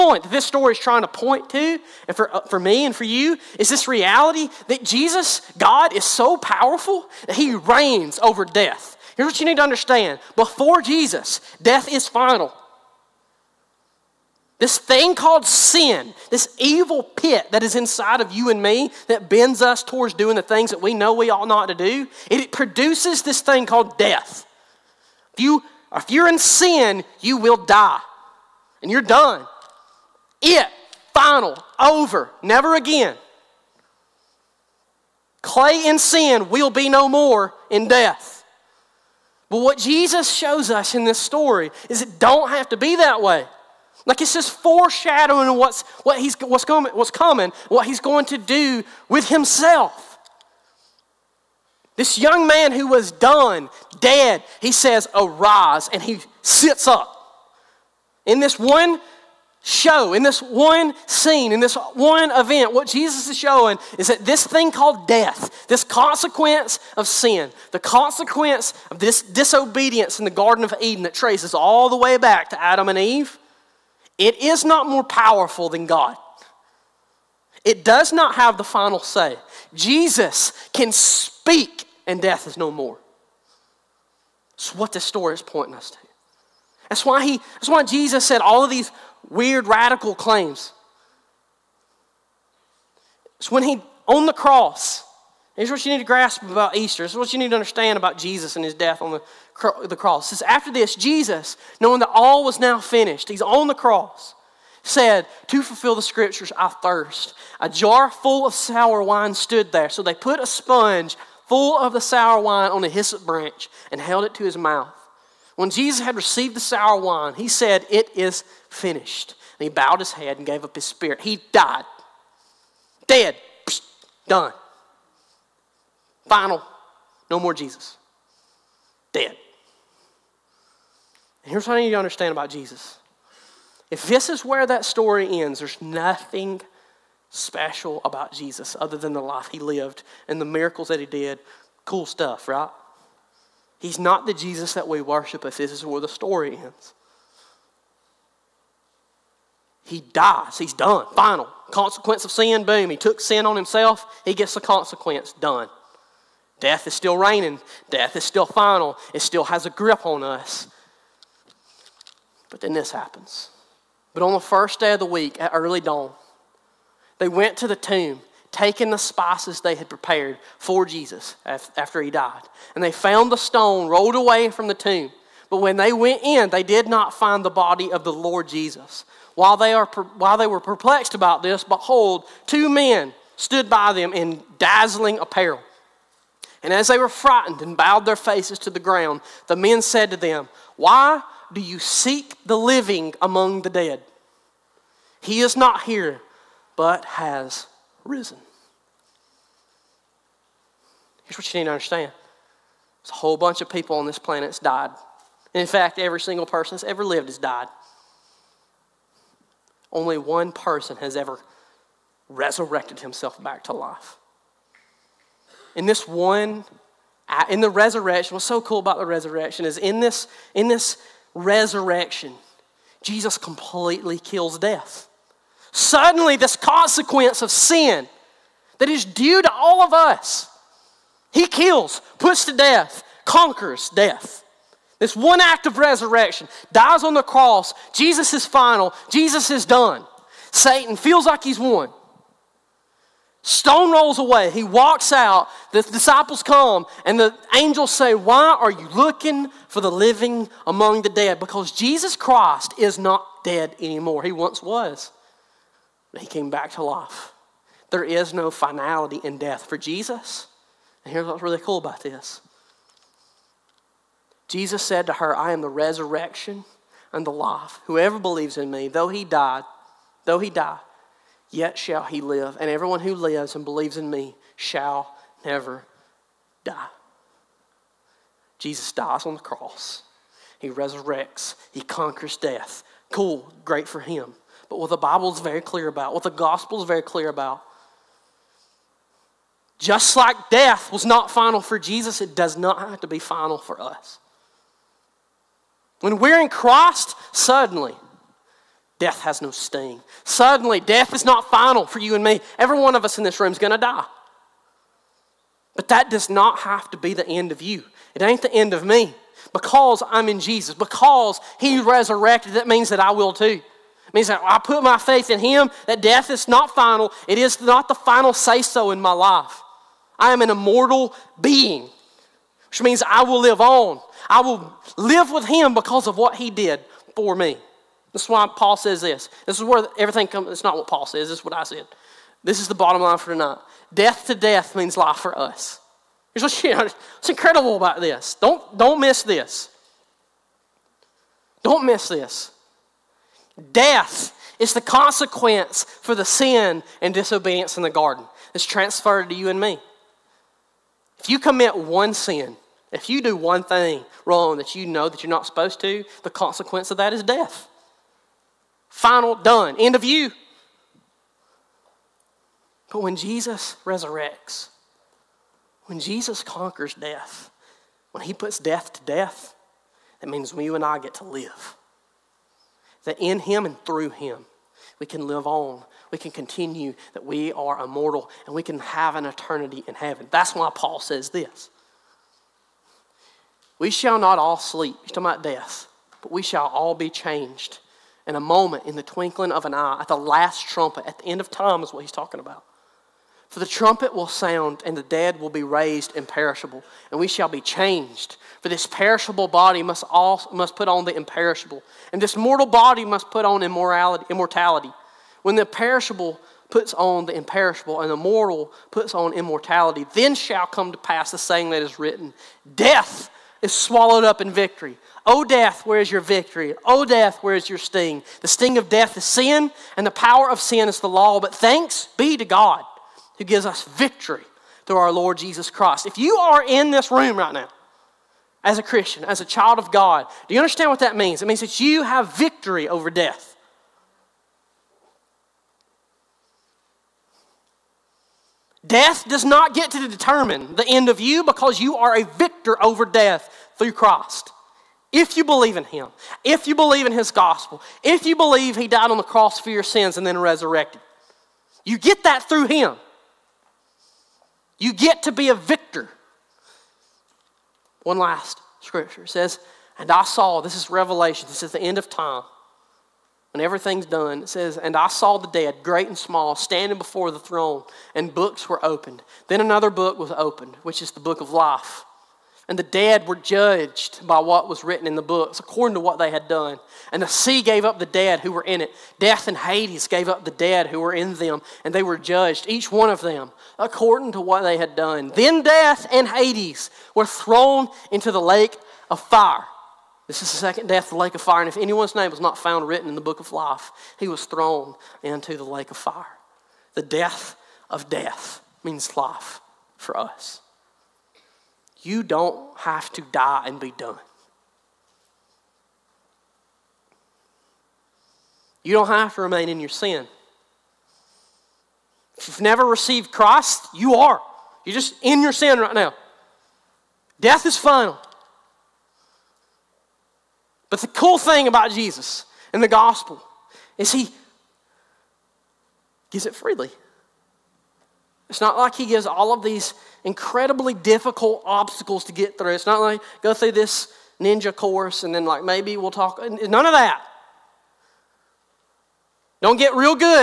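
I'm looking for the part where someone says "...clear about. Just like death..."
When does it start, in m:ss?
4:47.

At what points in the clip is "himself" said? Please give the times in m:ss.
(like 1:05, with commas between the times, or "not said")
0:49, 2:33, 3:33.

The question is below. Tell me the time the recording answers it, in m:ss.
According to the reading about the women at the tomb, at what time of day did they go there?
2:45.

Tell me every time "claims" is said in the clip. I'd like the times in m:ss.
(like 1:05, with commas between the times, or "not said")
1:30.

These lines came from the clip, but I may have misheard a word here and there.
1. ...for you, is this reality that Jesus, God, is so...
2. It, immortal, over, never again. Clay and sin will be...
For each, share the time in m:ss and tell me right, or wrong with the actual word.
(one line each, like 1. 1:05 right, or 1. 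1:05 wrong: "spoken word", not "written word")
1. 0:02 right
2. 0:30 wrong: "final", not "immortal".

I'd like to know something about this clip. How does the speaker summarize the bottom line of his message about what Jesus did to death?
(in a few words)
Death to death means life for us.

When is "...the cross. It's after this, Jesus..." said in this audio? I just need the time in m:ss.
1:39.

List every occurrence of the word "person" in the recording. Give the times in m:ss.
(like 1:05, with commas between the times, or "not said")
3:26, 3:30.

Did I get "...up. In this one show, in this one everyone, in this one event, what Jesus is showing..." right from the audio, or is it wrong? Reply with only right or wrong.
wrong.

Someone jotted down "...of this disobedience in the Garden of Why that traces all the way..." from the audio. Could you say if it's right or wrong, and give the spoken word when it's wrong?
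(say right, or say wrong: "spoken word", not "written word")
wrong: "Eden", not "Why".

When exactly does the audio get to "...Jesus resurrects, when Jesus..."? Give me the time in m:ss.
6:03.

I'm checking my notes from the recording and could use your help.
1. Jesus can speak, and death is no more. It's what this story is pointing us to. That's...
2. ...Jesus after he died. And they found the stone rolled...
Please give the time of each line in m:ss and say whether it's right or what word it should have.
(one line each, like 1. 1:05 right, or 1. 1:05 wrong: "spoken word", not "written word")
1. 1:19 right
2. 2:50 right.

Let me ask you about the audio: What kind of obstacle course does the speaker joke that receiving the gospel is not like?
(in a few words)
Ninja course.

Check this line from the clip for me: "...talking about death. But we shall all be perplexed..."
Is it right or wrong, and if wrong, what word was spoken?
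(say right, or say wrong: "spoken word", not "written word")
wrong: "changed", not "perplexed".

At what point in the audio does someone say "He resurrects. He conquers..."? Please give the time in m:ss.
4:40.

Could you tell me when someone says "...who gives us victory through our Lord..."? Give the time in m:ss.
7:03.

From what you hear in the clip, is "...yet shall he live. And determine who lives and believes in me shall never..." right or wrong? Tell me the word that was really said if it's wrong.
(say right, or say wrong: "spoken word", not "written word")
wrong: "everyone", not "determine".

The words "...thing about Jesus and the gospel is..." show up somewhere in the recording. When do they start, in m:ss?
8:41.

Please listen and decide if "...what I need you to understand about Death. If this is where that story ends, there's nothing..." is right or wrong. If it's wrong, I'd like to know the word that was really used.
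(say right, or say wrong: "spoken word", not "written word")
wrong: "Jesus", not "Death".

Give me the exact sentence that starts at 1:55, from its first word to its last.
When Jesus had received the sour wine, he said, It is finished.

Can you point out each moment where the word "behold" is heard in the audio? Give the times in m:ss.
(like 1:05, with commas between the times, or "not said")
3:01.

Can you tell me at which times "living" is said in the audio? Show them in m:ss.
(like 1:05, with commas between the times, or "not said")
3:12, 4:09.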